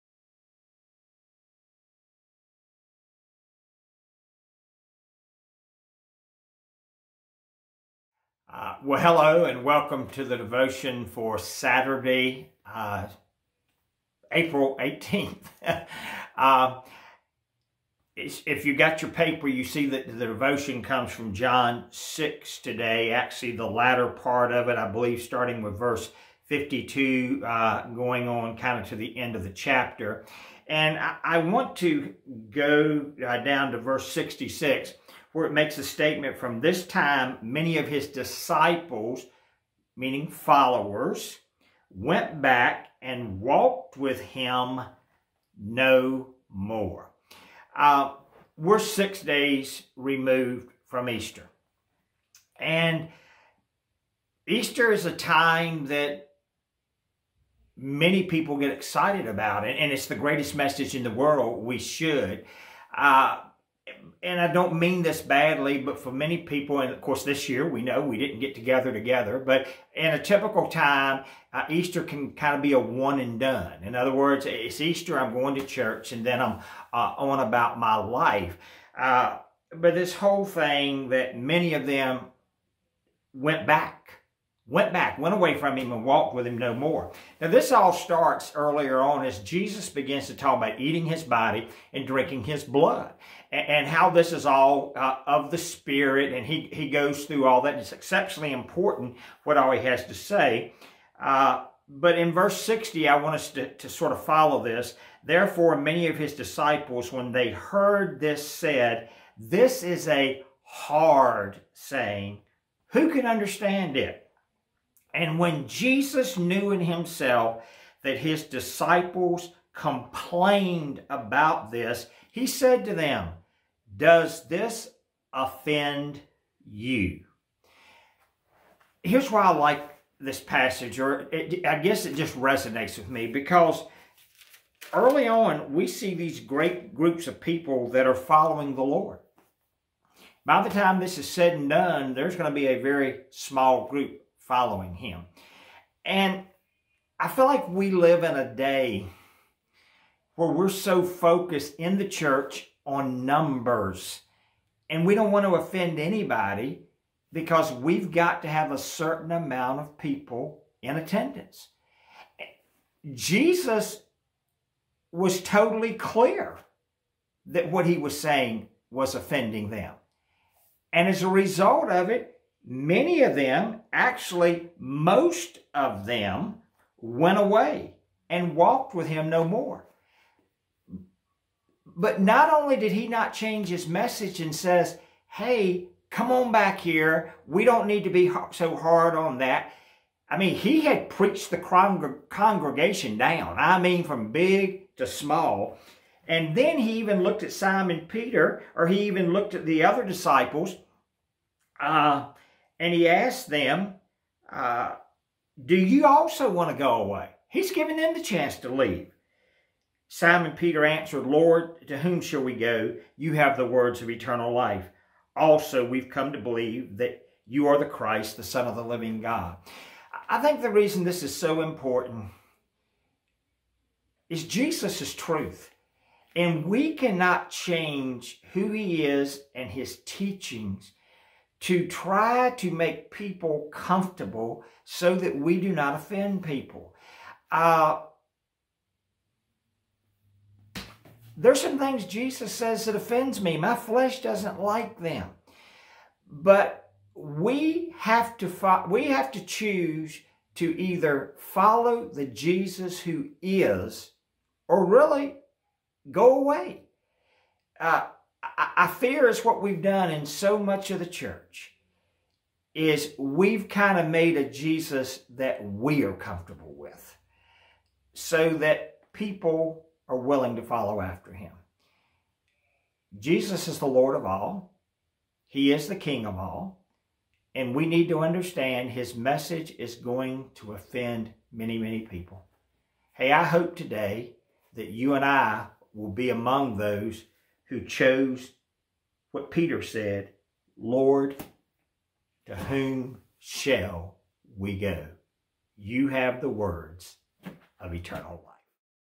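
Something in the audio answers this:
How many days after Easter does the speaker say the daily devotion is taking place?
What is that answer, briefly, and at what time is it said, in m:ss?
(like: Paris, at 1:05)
6, at 0:48.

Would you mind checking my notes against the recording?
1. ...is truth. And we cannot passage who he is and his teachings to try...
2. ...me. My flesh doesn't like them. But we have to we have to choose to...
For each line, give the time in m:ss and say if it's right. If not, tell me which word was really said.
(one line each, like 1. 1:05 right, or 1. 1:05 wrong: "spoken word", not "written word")
1. 3:45 wrong: "change", not "passage"
2. 4:03 right.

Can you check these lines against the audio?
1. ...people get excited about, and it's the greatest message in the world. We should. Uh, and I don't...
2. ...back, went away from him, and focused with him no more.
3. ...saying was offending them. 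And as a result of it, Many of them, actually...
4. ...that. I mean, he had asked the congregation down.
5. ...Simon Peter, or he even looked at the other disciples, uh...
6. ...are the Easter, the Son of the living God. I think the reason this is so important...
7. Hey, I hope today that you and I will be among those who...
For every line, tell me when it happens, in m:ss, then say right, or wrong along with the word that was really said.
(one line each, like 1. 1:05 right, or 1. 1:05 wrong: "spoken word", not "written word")
1. 0:58 right
2. 1:24 wrong: "walked", not "focused"
3. 2:48 right
4. 3:09 wrong: "preached", not "asked"
5. 3:17 right
6. 3:37 wrong: "Christ", not "Easter"
7. 4:43 right.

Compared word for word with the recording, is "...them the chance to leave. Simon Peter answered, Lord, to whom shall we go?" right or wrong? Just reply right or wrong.
right.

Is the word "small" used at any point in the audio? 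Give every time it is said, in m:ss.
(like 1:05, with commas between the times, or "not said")
2:23, 3:15.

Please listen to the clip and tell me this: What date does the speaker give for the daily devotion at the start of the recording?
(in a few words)
April 18th.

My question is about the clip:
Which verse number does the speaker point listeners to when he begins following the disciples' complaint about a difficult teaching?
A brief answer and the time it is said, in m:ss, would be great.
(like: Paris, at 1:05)
60, at 1:42.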